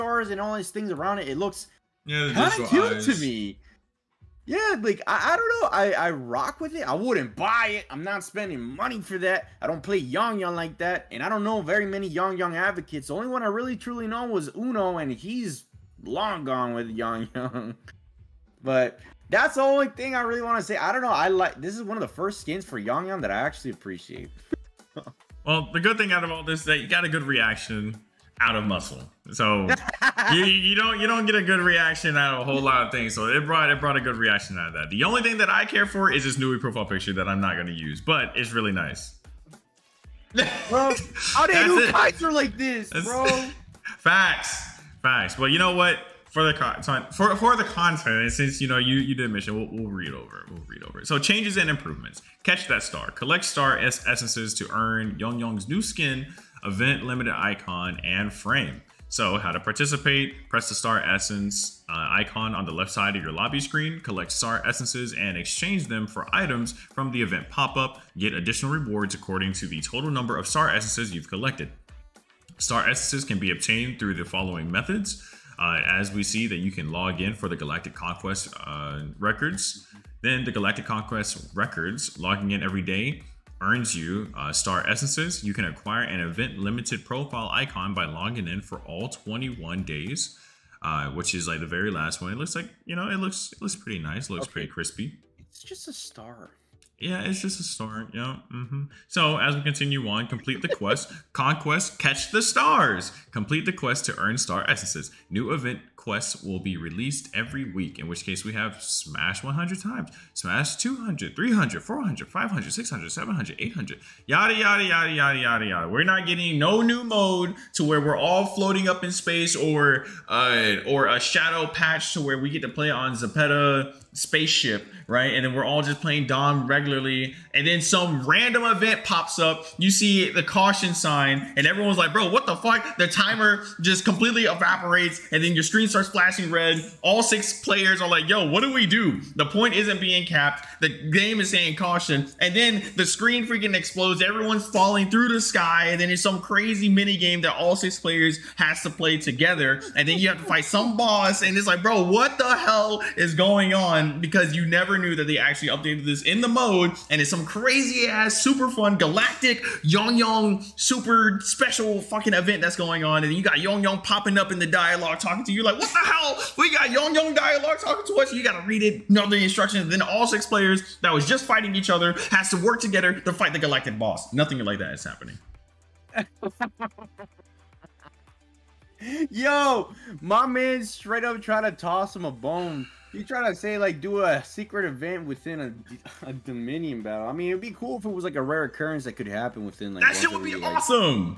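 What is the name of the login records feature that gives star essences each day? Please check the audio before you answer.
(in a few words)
Galactic Conquest records.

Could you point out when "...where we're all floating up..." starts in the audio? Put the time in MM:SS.
01:57.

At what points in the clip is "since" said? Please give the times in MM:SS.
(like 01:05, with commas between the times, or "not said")
00:48.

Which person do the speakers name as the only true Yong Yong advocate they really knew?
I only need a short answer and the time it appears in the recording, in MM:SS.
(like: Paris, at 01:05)
Uno, at 00:14.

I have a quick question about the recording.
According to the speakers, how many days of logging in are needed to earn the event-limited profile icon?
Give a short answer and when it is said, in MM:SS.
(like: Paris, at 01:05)
21, at 01:29.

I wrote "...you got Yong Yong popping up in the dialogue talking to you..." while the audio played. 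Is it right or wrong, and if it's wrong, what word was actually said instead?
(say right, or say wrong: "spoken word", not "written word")
right.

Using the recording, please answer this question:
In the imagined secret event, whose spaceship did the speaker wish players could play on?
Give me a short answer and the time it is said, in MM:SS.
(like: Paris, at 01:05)
Zeppeta, at 02:03.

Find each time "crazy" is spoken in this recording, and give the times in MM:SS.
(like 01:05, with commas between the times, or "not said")
02:26, 02:37.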